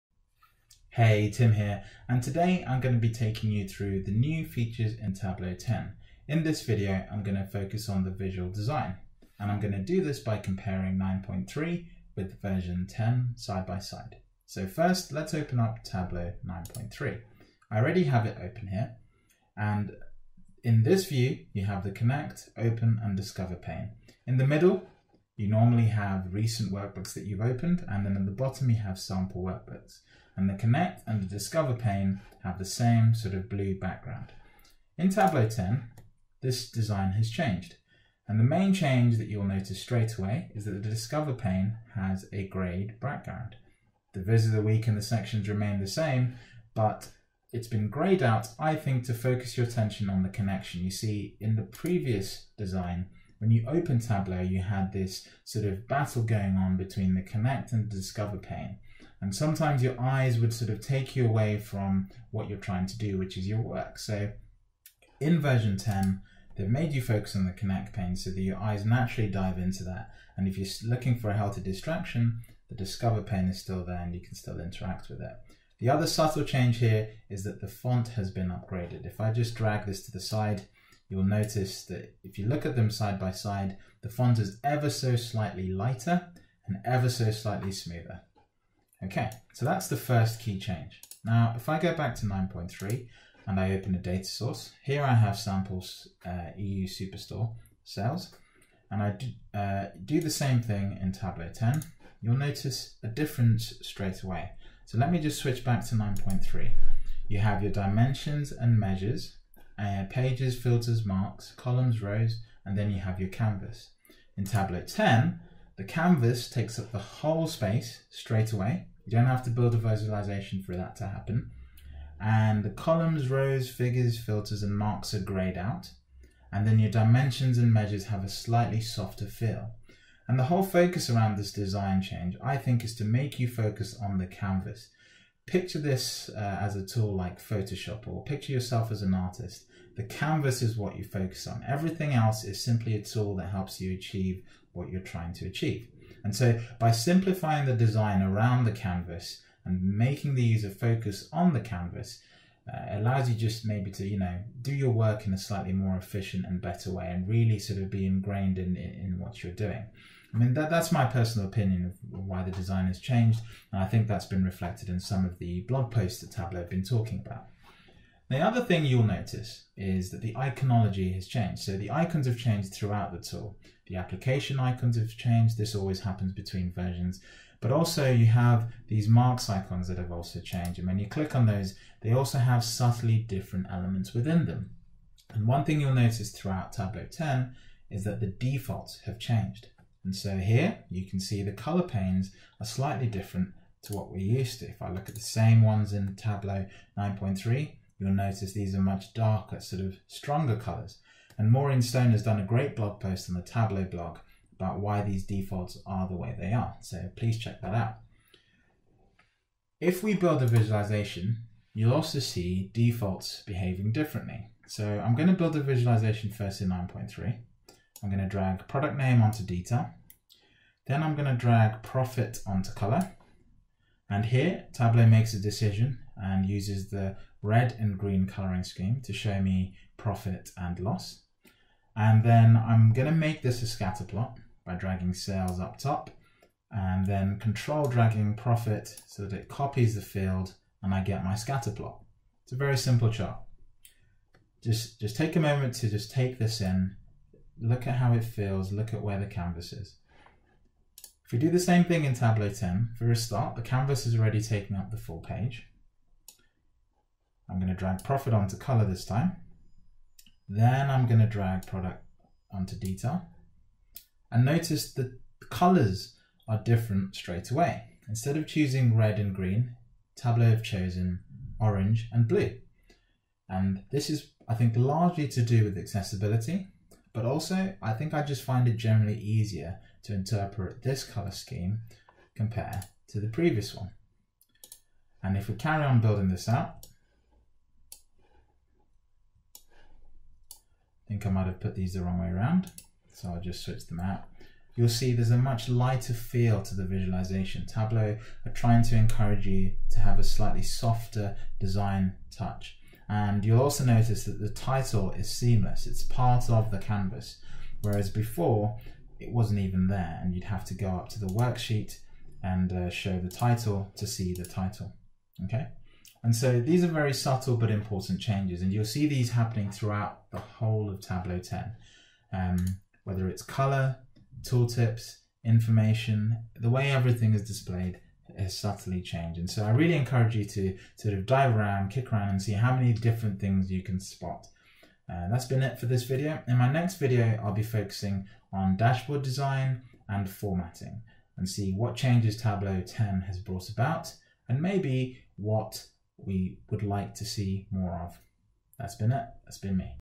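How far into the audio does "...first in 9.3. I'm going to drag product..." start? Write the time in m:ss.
3:36.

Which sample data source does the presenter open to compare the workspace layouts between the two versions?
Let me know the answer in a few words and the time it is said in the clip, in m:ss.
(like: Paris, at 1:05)
EU Superstore, at 1:36.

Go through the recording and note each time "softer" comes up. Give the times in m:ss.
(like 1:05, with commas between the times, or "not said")
2:08, 5:00.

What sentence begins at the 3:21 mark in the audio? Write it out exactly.
And Maureen Stone has done a great blog post on the Tableau blog about why these defaults are the way they are.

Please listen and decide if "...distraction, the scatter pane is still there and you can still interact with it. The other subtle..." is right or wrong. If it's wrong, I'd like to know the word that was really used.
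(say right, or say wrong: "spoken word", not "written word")
wrong: "discover", not "scatter".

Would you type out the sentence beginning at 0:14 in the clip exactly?
So first, let's open up Tableau 9.3.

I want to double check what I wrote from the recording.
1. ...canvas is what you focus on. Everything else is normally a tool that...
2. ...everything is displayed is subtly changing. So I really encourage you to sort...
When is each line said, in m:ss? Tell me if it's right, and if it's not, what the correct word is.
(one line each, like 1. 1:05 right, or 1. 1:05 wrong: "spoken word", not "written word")
1. 2:20 wrong: "simply", not "normally"
2. 5:26 right.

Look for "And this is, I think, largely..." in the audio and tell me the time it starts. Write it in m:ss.
4:33.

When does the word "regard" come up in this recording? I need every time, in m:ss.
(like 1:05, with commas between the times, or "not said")
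not said.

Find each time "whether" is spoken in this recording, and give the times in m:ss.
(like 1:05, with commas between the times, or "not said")
5:23.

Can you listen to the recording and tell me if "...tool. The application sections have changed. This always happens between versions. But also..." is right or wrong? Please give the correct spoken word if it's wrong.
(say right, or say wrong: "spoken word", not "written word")
wrong: "icons", not "sections".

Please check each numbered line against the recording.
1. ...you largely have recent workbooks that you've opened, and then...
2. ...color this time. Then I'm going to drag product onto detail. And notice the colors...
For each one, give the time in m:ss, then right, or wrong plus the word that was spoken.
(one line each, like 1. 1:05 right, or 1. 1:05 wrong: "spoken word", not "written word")
1. 0:25 wrong: "normally", not "largely"
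2. 4:18 right.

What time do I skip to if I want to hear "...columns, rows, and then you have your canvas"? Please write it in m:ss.
1:51.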